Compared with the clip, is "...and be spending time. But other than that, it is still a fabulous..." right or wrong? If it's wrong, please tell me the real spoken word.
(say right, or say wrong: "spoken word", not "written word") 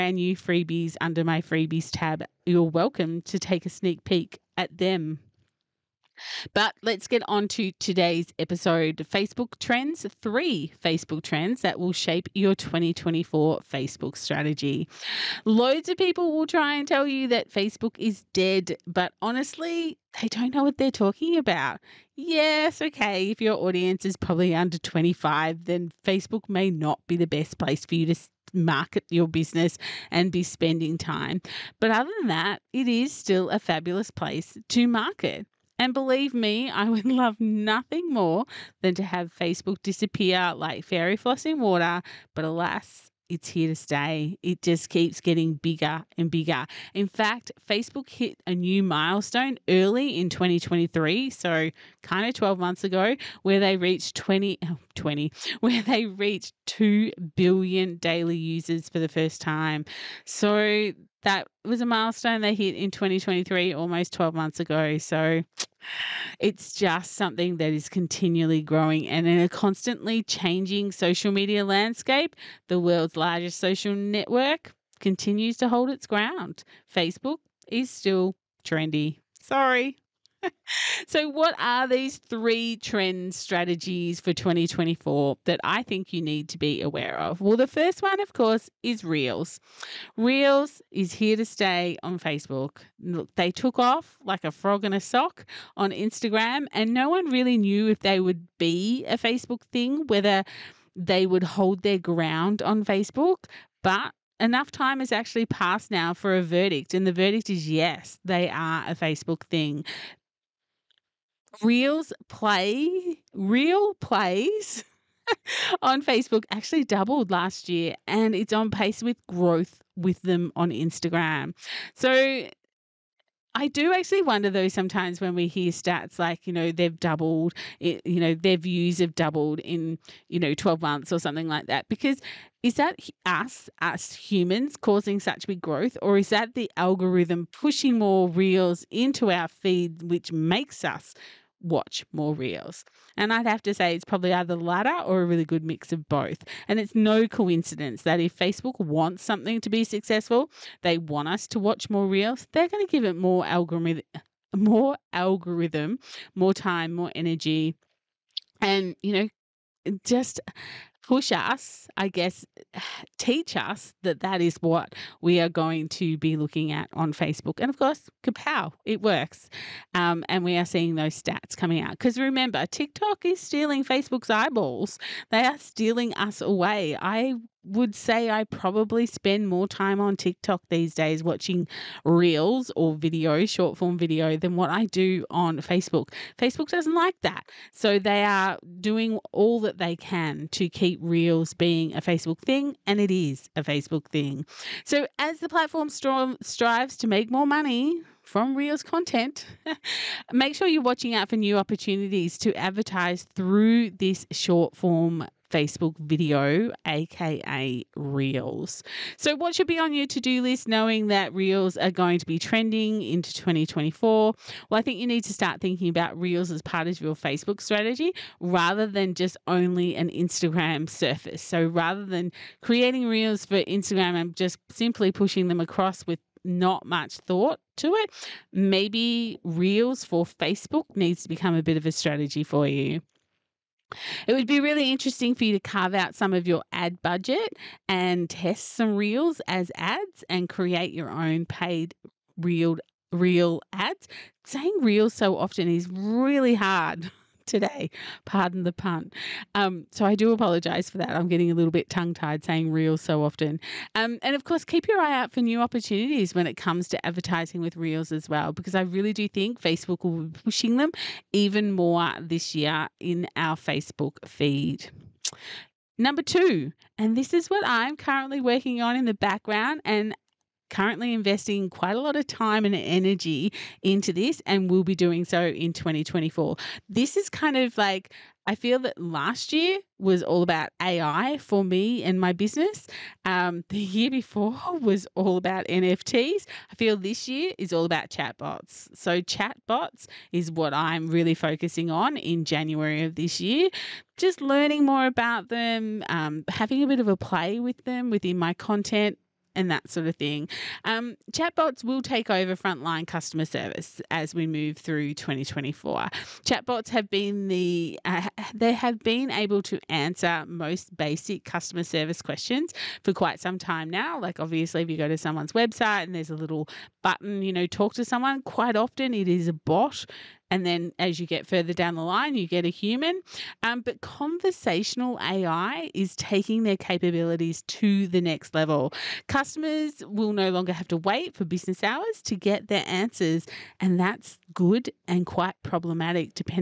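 right.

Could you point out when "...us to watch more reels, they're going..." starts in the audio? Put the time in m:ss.
2:31.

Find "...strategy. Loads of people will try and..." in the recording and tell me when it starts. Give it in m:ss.
0:14.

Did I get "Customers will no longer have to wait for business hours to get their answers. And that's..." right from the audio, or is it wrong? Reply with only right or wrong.
right.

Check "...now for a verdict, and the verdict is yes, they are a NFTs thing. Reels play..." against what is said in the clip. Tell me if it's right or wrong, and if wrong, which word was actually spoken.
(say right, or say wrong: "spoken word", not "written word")
wrong: "Facebook", not "NFTs".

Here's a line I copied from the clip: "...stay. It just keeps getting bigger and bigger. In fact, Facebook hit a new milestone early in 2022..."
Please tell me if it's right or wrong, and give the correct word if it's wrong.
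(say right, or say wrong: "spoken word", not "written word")
wrong: "2023", not "2022".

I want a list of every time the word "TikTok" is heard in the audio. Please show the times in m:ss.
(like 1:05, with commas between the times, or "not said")
2:52, 3:00.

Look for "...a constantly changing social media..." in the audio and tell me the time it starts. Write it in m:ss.
1:09.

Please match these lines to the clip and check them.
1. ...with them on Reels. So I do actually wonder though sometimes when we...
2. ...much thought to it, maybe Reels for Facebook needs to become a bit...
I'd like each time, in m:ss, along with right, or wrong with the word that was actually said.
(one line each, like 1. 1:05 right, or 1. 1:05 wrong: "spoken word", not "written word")
1. 1:59 wrong: "Instagram", not "Reels"
2. 3:46 right.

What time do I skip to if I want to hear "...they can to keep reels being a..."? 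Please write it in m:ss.
3:09.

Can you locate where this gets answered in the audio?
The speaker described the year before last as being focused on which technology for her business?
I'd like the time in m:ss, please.
4:45.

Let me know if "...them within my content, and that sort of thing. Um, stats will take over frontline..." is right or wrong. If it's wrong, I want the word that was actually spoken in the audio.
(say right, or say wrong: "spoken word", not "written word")
wrong: "chatbots", not "stats".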